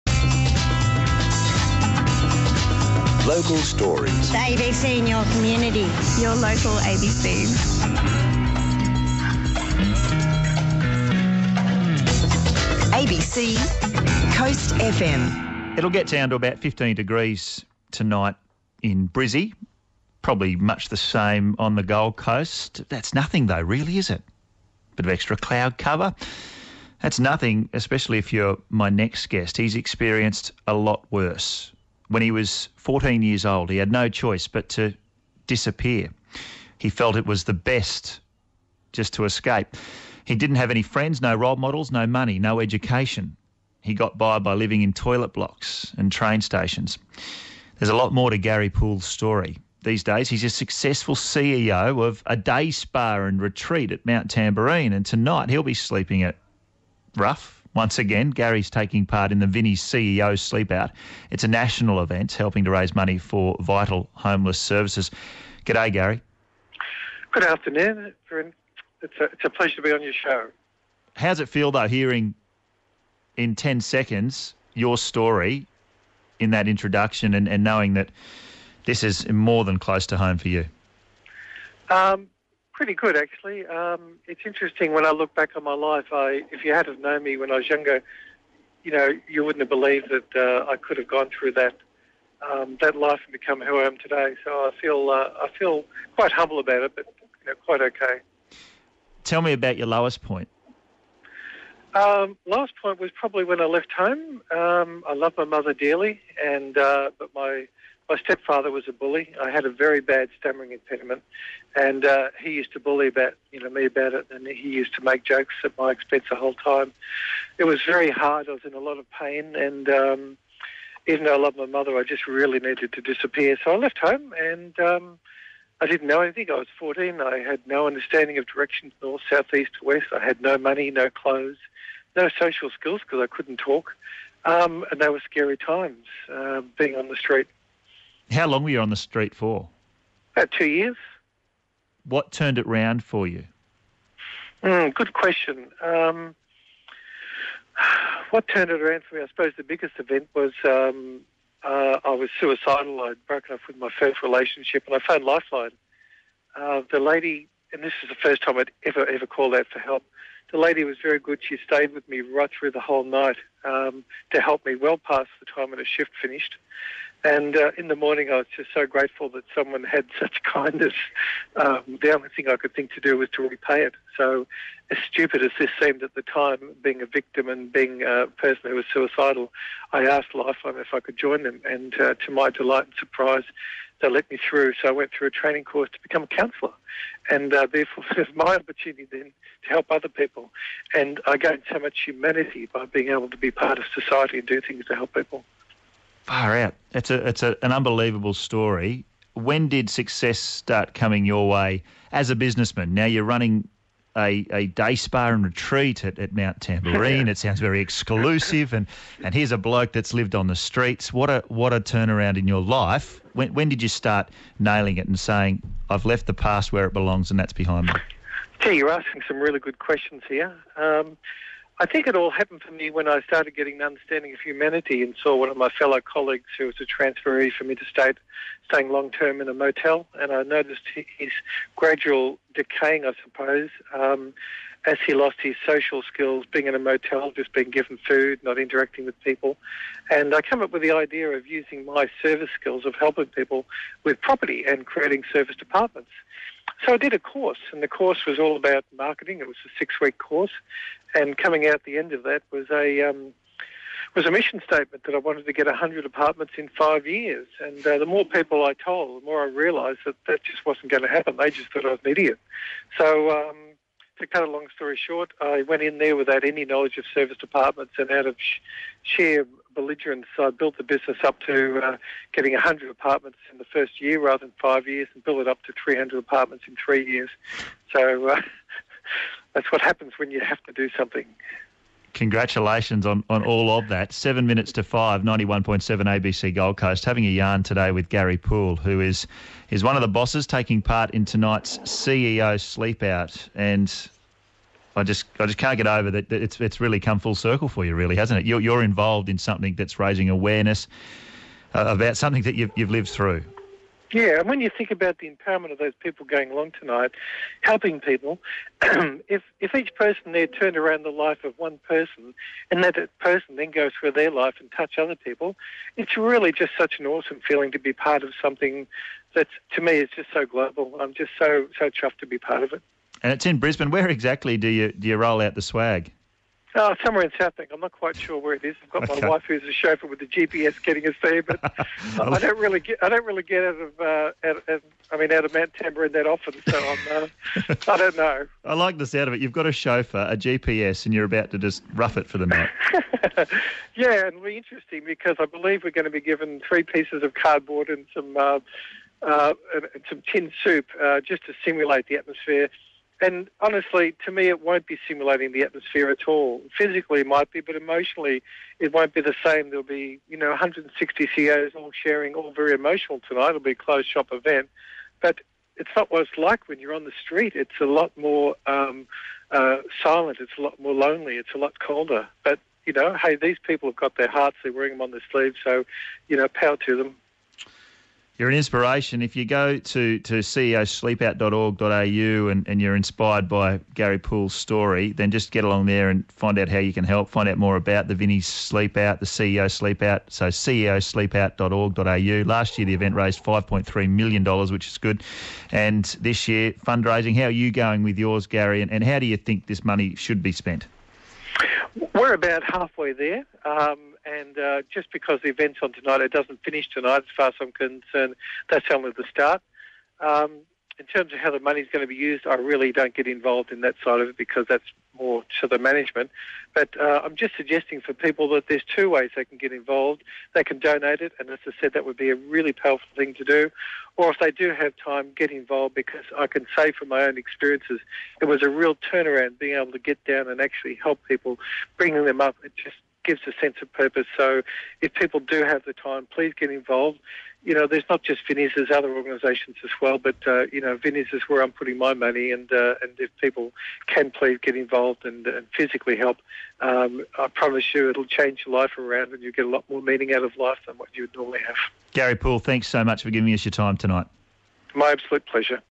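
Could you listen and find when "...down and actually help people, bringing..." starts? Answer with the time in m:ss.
7:10.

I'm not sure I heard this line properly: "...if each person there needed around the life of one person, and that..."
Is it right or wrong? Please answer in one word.
wrong.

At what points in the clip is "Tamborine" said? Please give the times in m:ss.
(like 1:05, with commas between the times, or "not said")
0:54, 3:26, 5:35.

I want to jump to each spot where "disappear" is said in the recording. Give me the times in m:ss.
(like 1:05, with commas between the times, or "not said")
0:35, 2:03.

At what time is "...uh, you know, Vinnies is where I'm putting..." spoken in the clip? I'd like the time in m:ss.
7:20.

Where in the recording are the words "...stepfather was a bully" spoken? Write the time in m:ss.
1:48.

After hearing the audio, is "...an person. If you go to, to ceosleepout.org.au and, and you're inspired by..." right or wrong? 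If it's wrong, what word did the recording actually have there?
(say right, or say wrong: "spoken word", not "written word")
wrong: "inspiration", not "person".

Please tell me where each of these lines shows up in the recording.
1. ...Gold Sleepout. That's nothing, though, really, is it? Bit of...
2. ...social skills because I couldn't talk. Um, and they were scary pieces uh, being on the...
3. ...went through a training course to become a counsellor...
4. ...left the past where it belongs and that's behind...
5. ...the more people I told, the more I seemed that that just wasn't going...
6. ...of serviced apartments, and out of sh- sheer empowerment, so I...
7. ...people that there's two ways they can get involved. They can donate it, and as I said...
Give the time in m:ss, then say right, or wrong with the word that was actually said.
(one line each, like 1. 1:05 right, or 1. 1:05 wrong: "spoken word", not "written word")
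1. 0:21 wrong: "Coast", not "Sleepout"
2. 2:12 wrong: "times", not "pieces"
3. 3:04 right
4. 3:36 right
5. 4:17 wrong: "realised", not "seemed"
6. 4:26 wrong: "belligerent", not "empowerment"
7. 6:58 right.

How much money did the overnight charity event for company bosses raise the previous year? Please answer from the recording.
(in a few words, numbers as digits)
$5.3 million.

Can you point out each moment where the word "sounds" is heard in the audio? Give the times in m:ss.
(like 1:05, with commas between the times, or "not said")
3:27, 5:39.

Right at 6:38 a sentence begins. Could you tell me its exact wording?
And, and how do you think this money should be spent?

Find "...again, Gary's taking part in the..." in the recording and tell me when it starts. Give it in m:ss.
0:57.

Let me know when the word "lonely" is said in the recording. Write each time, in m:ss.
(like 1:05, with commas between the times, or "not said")
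6:10.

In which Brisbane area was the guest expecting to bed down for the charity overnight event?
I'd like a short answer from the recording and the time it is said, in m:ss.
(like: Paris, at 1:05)
Southbank, at 5:27.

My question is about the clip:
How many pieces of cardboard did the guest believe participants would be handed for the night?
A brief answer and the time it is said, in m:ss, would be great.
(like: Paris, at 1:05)
3, at 5:46.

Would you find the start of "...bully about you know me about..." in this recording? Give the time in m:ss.
1:52.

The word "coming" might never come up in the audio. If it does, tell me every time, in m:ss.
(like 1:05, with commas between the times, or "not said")
3:20, 4:11.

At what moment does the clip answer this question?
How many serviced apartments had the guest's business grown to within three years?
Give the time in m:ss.
4:35.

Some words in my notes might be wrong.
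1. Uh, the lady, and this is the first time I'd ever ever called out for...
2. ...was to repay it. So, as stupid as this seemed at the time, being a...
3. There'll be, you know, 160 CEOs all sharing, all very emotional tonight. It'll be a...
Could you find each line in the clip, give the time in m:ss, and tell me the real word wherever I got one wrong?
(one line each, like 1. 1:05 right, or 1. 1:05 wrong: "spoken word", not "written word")
1. 2:36 right
2. 2:53 right
3. 5:59 right.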